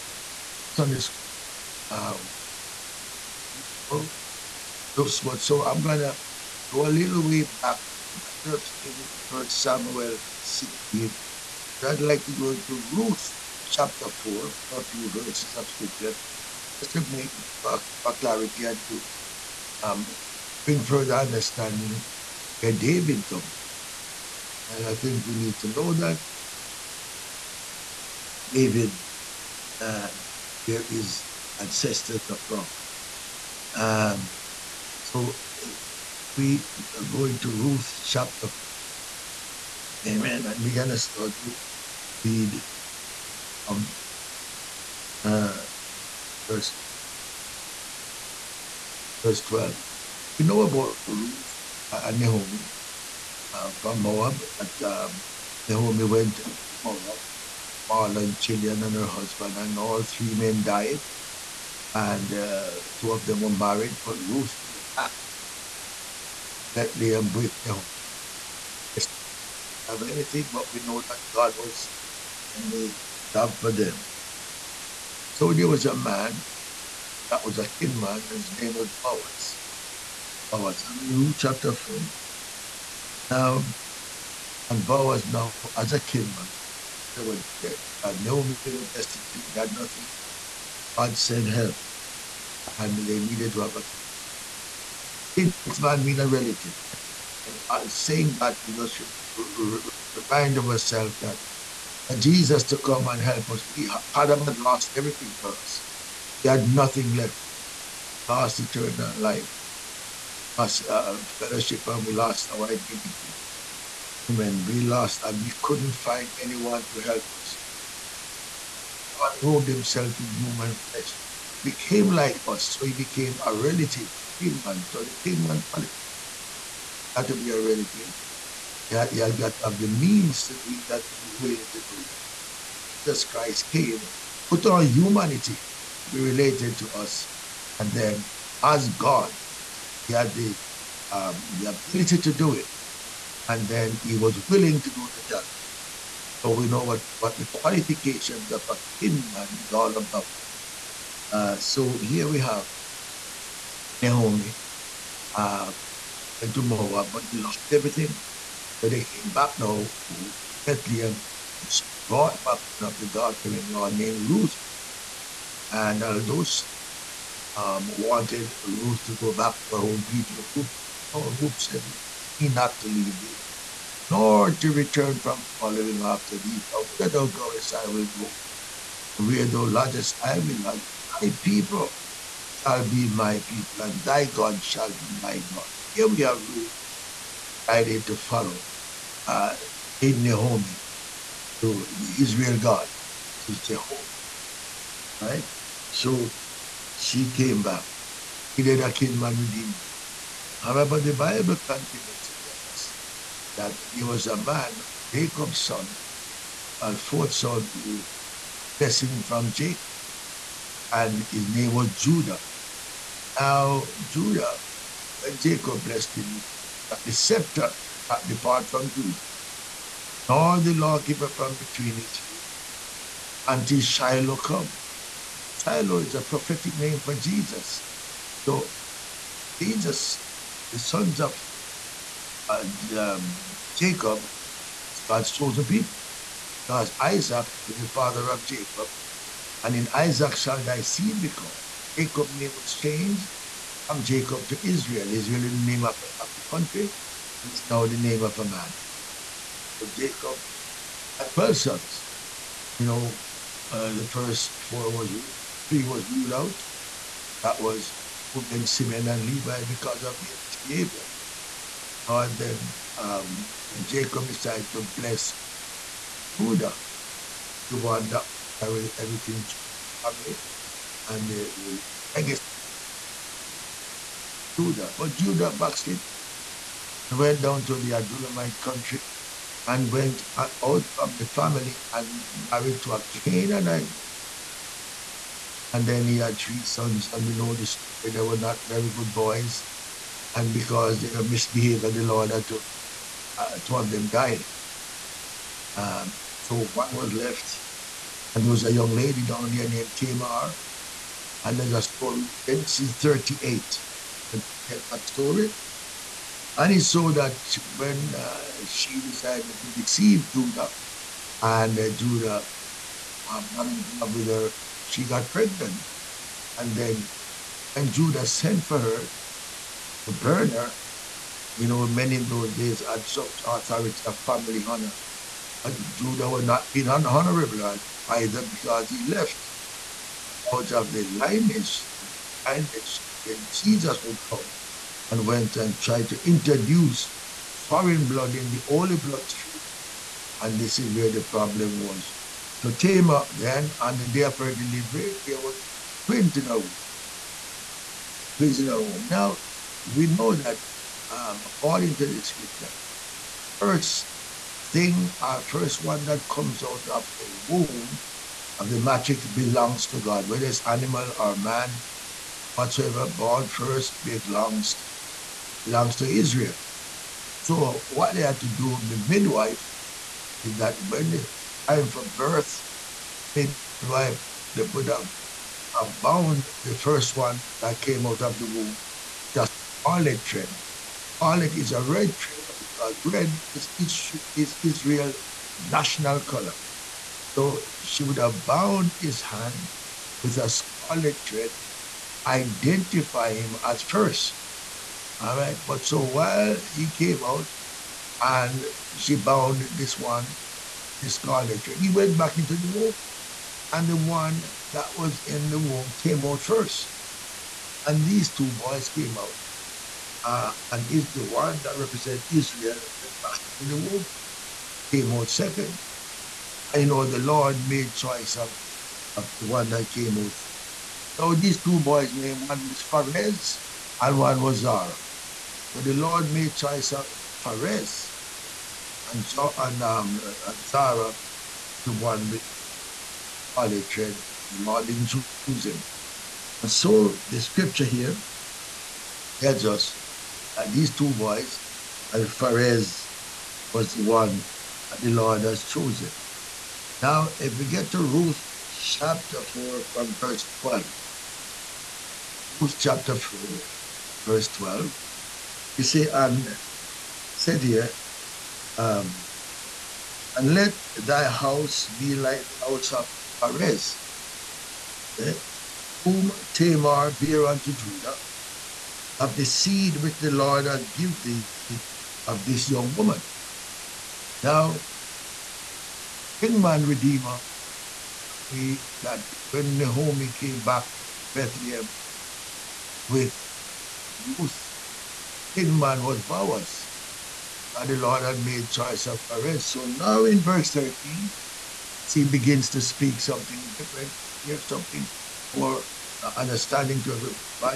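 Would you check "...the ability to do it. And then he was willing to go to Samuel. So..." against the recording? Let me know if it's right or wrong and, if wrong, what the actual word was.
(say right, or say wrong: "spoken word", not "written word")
wrong: "Calvary", not "Samuel".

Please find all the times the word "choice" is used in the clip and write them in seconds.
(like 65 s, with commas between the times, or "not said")
417 s, 426 s, 488 s.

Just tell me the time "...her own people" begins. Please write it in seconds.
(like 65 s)
169 s.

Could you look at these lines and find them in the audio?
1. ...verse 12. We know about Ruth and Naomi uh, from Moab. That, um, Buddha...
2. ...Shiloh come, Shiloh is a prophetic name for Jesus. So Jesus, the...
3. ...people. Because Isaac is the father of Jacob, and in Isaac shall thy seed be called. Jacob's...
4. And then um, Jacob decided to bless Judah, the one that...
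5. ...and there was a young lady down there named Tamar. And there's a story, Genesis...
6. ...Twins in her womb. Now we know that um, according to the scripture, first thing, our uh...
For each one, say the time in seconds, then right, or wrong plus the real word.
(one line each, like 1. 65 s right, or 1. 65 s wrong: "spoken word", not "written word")
1. 49 s wrong: "Naomi", not "Buddha"
2. 223 s right
3. 235 s right
4. 262 s right
5. 298 s right
6. 346 s right.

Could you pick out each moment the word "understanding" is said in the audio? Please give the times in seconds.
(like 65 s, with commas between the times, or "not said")
21 s, 496 s.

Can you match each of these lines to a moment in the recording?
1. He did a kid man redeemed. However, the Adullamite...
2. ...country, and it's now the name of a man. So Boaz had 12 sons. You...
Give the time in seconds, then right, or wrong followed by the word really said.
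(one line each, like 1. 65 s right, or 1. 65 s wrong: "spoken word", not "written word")
1. 198 s wrong: "Bible", not "Adullamite"
2. 246 s wrong: "Jacob", not "Boaz".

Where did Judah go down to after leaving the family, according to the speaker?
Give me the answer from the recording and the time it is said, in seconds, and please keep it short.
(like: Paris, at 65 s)
Adullamite country, at 277 s.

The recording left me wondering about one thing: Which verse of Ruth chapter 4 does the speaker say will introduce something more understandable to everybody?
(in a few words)
13.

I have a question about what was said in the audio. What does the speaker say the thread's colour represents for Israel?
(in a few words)
National color.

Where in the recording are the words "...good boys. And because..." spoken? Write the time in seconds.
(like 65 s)
288 s.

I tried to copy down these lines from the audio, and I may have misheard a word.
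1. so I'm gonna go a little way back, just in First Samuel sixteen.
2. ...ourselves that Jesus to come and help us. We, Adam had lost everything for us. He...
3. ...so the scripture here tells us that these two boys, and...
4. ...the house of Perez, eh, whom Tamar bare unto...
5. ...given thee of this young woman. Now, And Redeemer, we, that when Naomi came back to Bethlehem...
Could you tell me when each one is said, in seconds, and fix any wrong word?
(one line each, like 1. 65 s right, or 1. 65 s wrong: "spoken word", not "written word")
1. 5 s right
2. 100 s right
3. 436 s right
4. 462 s right
5. 470 s wrong: "Kinsman", not "And".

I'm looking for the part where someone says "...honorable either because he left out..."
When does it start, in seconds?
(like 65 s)
326 s.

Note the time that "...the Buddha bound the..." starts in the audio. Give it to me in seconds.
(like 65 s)
374 s.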